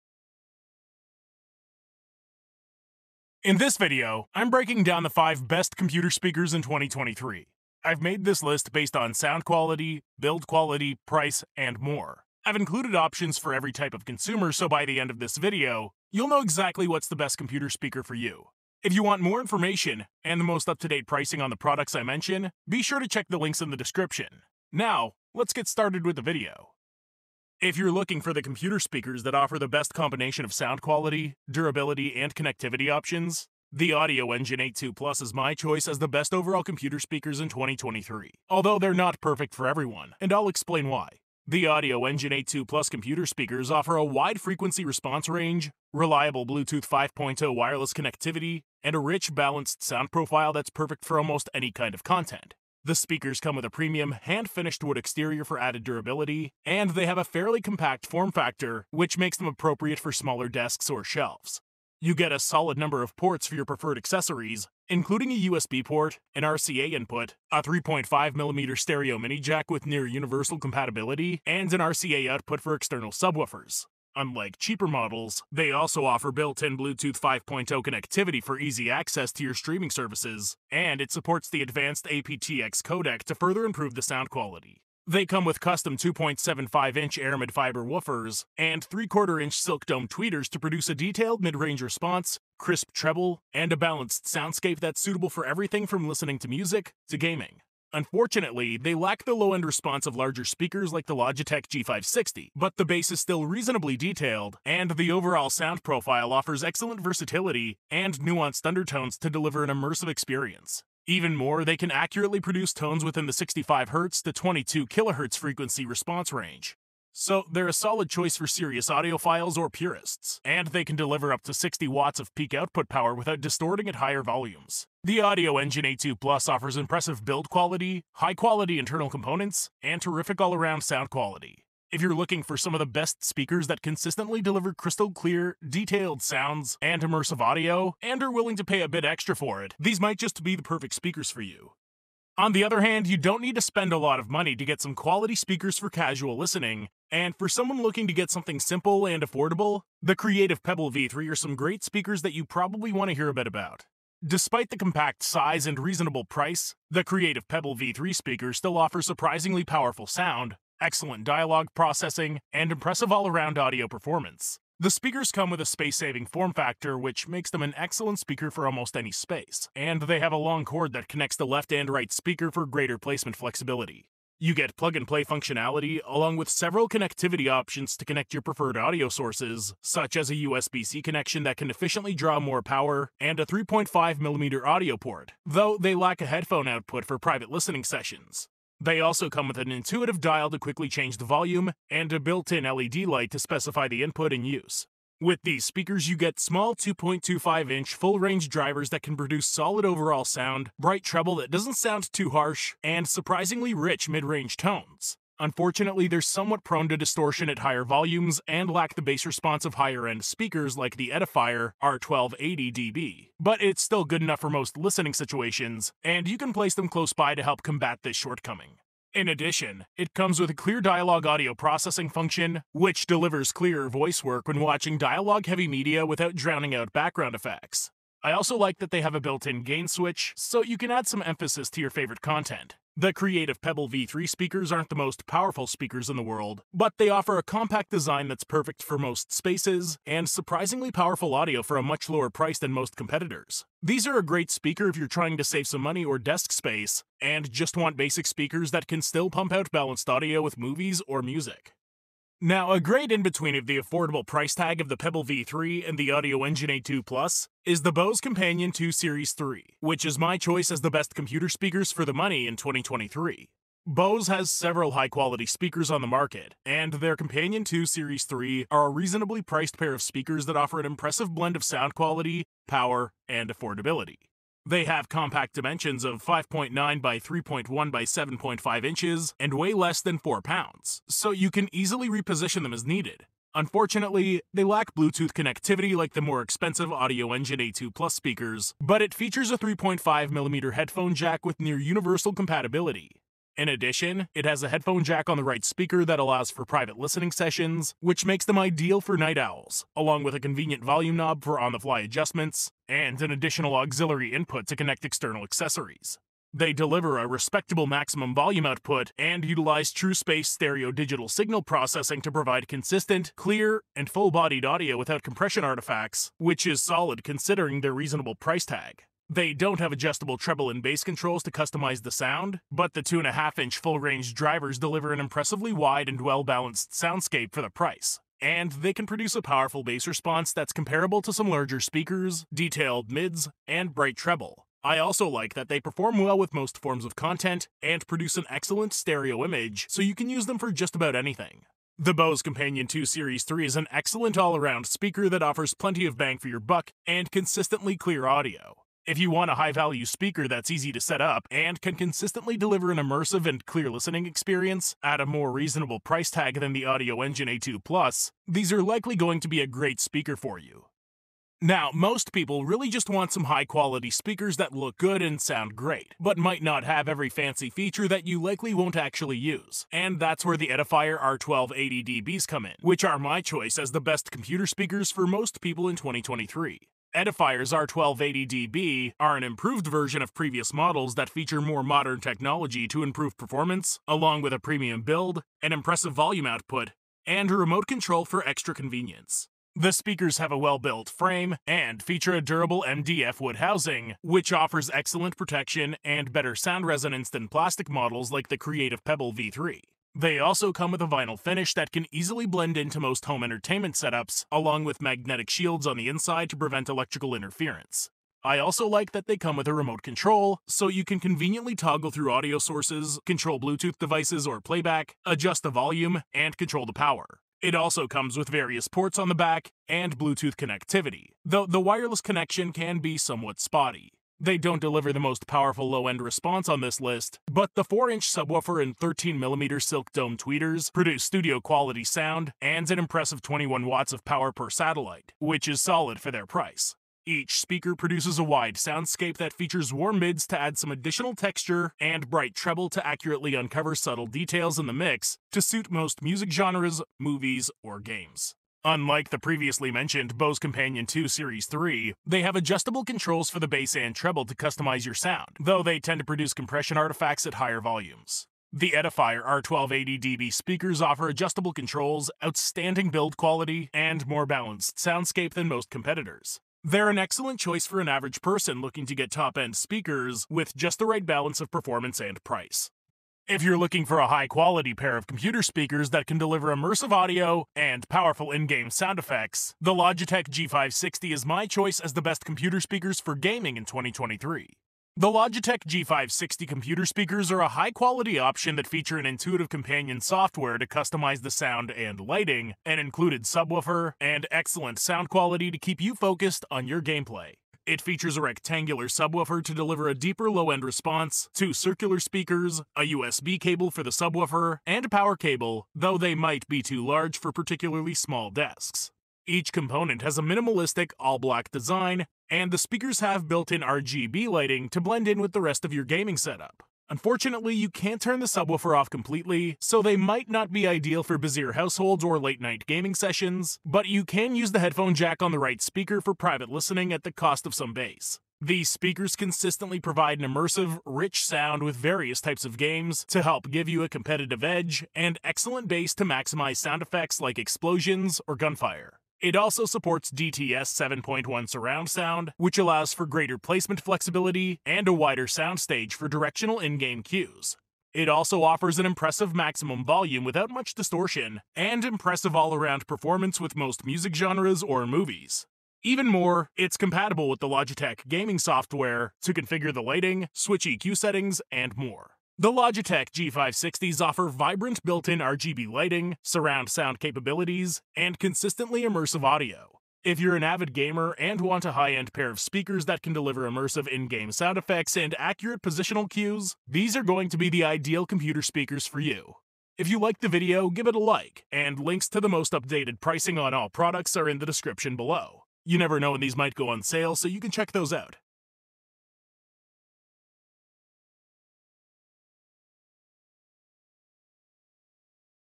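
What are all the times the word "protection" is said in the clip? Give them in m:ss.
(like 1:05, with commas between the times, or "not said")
6:35.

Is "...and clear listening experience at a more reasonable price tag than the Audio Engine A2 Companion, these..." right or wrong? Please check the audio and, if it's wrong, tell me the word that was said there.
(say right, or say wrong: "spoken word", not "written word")
wrong: "Plus", not "Companion".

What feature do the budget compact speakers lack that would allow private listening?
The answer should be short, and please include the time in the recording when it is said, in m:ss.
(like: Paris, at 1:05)
headphone output, at 3:06.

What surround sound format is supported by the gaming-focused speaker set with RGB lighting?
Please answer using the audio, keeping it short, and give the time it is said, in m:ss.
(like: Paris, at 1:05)
DTS 7.1, at 9:00.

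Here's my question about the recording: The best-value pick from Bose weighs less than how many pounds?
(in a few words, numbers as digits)
4 pounds.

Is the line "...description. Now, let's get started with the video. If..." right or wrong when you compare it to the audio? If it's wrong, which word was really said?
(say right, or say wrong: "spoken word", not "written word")
right.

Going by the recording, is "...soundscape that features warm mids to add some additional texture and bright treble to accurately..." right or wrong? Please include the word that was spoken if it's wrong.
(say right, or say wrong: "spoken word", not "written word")
right.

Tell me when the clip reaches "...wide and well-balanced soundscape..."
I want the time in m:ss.
5:25.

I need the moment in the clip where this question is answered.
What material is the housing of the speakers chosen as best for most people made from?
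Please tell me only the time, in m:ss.
6:32.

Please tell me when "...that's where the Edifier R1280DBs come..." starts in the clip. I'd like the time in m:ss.
6:10.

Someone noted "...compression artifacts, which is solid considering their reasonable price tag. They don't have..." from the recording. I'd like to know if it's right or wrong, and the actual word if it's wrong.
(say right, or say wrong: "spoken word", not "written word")
right.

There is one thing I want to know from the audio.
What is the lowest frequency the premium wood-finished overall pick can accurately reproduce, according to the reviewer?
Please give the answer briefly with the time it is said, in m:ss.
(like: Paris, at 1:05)
65Hz, at 1:53.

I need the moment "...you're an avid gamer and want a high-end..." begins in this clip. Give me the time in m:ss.
9:30.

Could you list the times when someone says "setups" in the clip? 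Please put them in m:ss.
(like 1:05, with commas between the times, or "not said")
6:43, 8:36.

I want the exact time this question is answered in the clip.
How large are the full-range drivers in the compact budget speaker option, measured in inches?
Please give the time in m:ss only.
3:16.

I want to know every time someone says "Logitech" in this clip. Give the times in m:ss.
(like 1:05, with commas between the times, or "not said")
1:41, 7:59, 8:05, 9:17, 9:22.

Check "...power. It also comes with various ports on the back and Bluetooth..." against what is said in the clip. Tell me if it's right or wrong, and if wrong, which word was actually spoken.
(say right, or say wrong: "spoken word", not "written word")
right.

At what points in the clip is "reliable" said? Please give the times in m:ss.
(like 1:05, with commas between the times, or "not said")
0:45.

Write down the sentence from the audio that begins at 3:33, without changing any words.
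But it's still good enough for most listening situations, and you can place them close by to help combat this shortcoming.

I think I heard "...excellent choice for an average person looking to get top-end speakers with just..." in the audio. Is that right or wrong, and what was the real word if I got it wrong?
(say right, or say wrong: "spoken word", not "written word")
right.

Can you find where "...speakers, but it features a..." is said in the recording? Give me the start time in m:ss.
4:48.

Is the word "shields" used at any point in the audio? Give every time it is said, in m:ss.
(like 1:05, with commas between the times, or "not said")
6:45.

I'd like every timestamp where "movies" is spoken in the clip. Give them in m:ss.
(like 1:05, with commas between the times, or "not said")
4:10, 7:27, 9:15.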